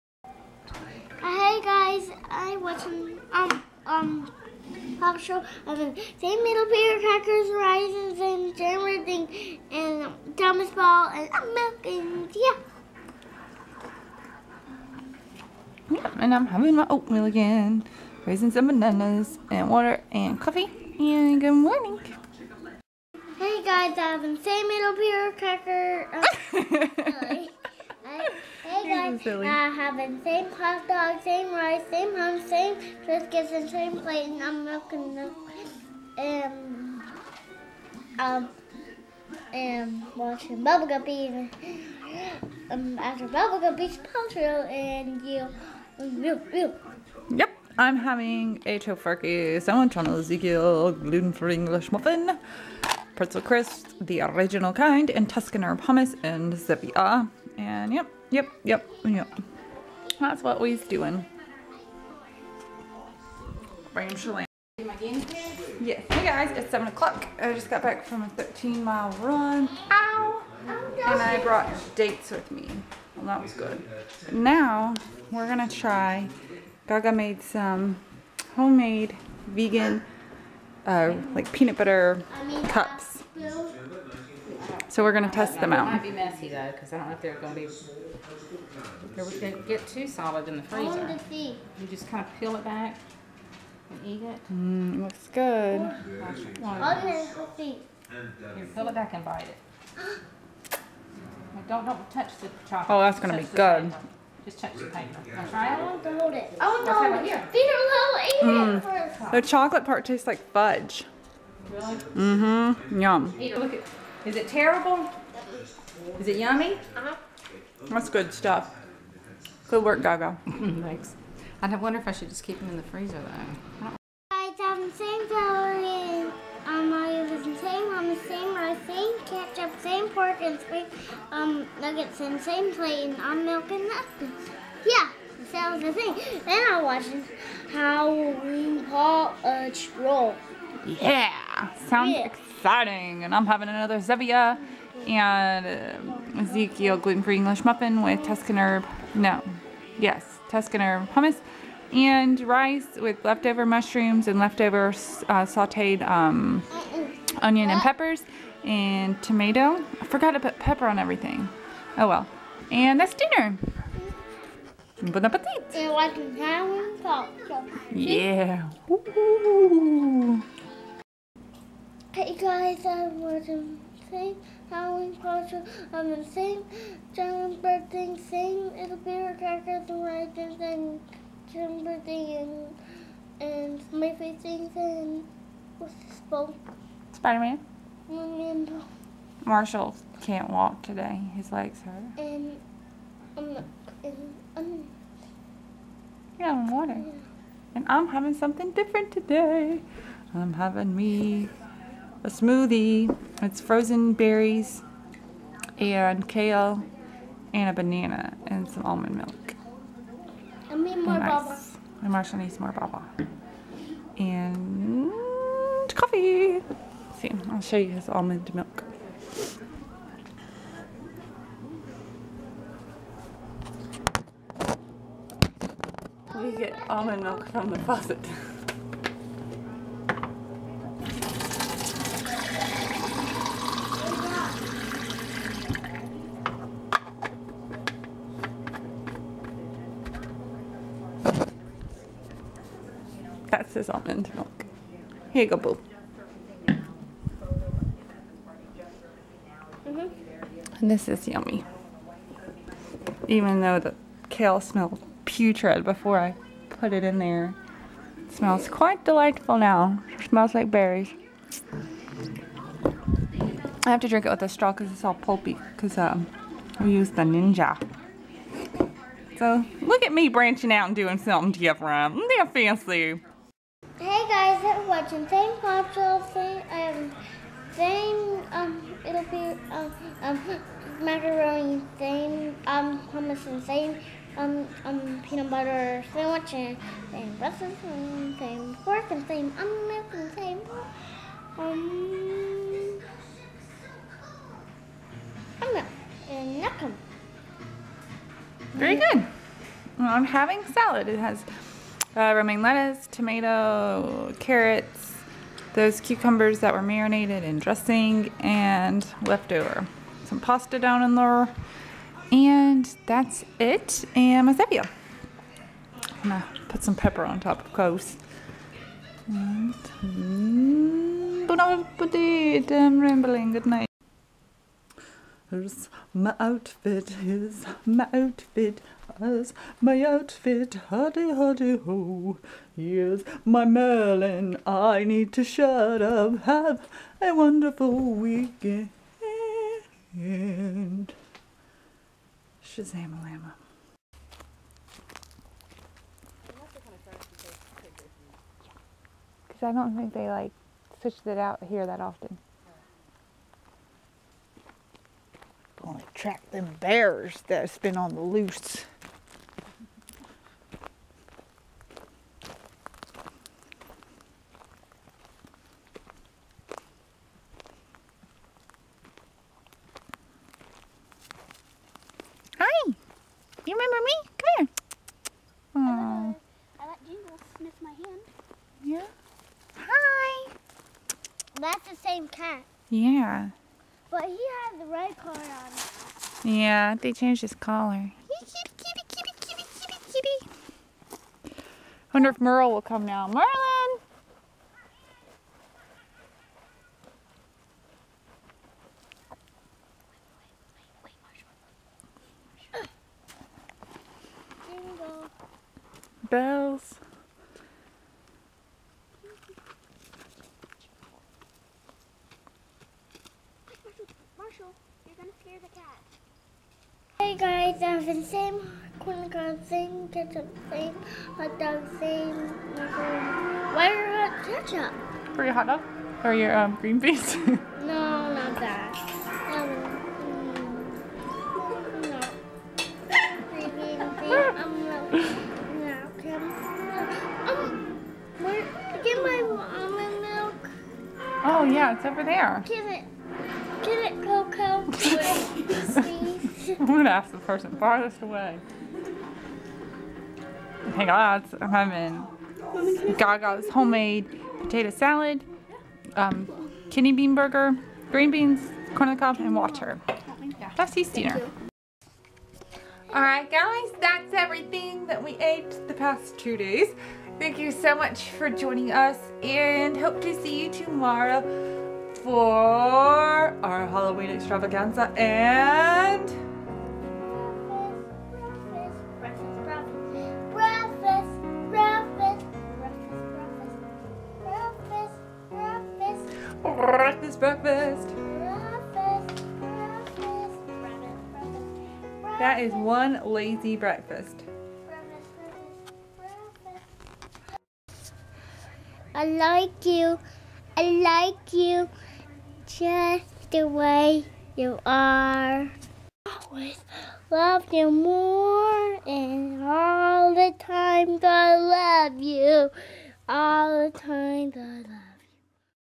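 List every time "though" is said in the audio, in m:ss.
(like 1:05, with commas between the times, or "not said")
1:26, 2:03, 4:13.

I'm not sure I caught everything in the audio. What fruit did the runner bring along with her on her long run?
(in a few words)
Dates.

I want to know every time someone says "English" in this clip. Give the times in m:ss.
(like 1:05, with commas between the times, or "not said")
0:51, 2:27.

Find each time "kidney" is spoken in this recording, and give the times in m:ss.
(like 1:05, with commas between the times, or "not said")
7:36.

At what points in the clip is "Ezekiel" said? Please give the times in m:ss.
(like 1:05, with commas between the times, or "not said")
0:50, 2:26.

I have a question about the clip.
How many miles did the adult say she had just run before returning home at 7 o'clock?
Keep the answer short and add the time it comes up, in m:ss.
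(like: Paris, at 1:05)
13, at 1:08.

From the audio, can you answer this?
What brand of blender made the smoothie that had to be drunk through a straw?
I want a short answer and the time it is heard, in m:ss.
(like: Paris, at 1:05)
Ninja, at 4:27.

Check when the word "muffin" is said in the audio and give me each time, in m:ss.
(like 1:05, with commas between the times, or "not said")
0:51, 2:27.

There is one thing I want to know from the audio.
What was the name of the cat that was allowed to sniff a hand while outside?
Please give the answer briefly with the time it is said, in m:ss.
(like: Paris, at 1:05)
Jingle, at 6:17.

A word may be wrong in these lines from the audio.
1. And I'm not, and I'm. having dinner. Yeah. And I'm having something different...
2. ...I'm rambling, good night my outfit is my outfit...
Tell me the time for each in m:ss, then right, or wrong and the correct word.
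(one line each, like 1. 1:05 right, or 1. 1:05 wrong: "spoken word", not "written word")
1. 3:12 wrong: "water", not "dinner"
2. 5:22 right.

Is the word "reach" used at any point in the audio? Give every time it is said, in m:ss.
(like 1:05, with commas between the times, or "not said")
not said.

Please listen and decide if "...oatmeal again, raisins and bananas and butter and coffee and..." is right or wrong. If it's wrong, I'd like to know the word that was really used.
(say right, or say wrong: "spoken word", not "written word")
wrong: "water", not "butter".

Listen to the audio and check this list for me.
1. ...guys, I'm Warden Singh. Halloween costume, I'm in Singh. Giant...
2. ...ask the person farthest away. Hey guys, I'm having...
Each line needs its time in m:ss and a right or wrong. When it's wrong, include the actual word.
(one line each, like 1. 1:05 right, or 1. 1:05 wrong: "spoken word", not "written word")
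1. 2:52 right
2. 7:27 right.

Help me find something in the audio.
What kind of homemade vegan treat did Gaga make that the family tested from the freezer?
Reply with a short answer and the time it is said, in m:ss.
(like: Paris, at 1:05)
Peanut butter cups, at 1:21.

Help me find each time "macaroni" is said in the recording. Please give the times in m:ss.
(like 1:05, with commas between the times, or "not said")
4:41, 7:02.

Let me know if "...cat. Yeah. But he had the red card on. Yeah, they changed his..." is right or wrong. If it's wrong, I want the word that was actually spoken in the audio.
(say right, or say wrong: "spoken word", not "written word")
right.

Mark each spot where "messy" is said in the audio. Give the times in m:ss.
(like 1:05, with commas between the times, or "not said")
1:26.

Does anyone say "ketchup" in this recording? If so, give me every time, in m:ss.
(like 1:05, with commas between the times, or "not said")
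2:09, 7:00, 7:04.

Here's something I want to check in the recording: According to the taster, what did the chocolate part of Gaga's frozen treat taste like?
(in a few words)
Fudge.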